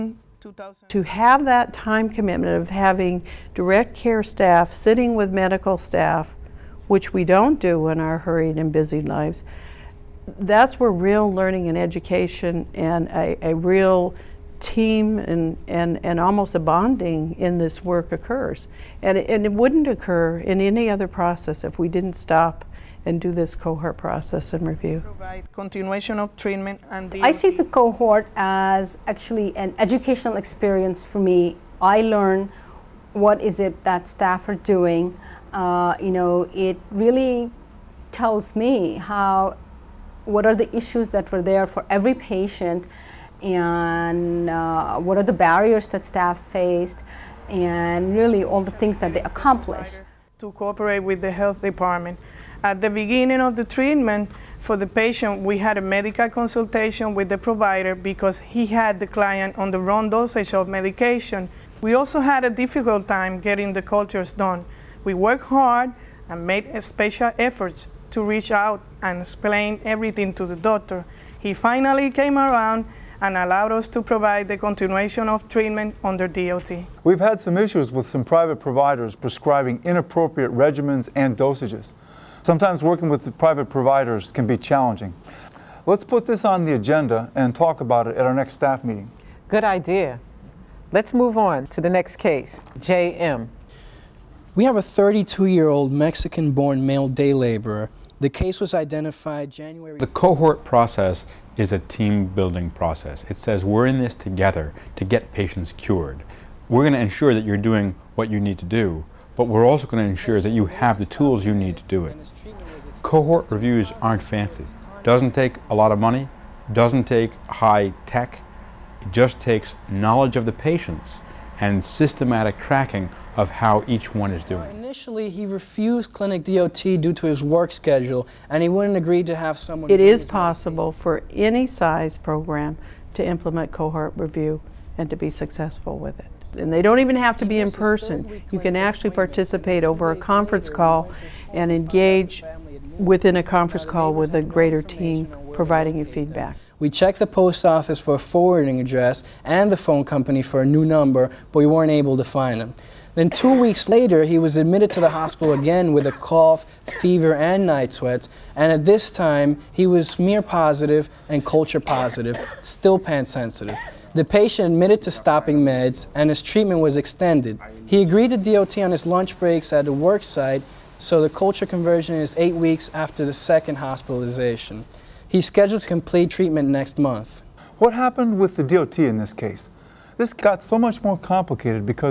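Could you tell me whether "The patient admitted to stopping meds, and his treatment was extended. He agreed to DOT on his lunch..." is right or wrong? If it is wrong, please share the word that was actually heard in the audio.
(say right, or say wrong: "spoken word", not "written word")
right.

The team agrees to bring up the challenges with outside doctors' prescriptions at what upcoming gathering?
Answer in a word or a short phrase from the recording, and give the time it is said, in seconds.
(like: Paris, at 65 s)
next staff meeting, at 88 s.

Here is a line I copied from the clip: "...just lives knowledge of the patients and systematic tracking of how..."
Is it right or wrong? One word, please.
wrong.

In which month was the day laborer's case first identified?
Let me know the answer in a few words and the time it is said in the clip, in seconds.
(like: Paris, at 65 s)
January, at 99 s.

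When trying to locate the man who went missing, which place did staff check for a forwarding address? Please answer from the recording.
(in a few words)
post office.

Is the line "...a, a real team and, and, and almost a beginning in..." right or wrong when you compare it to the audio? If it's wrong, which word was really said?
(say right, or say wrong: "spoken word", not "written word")
wrong: "bonding", not "beginning".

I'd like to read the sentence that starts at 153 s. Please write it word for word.
Then two weeks later, he was admitted to the hospital again with a cough, fever, and night sweats.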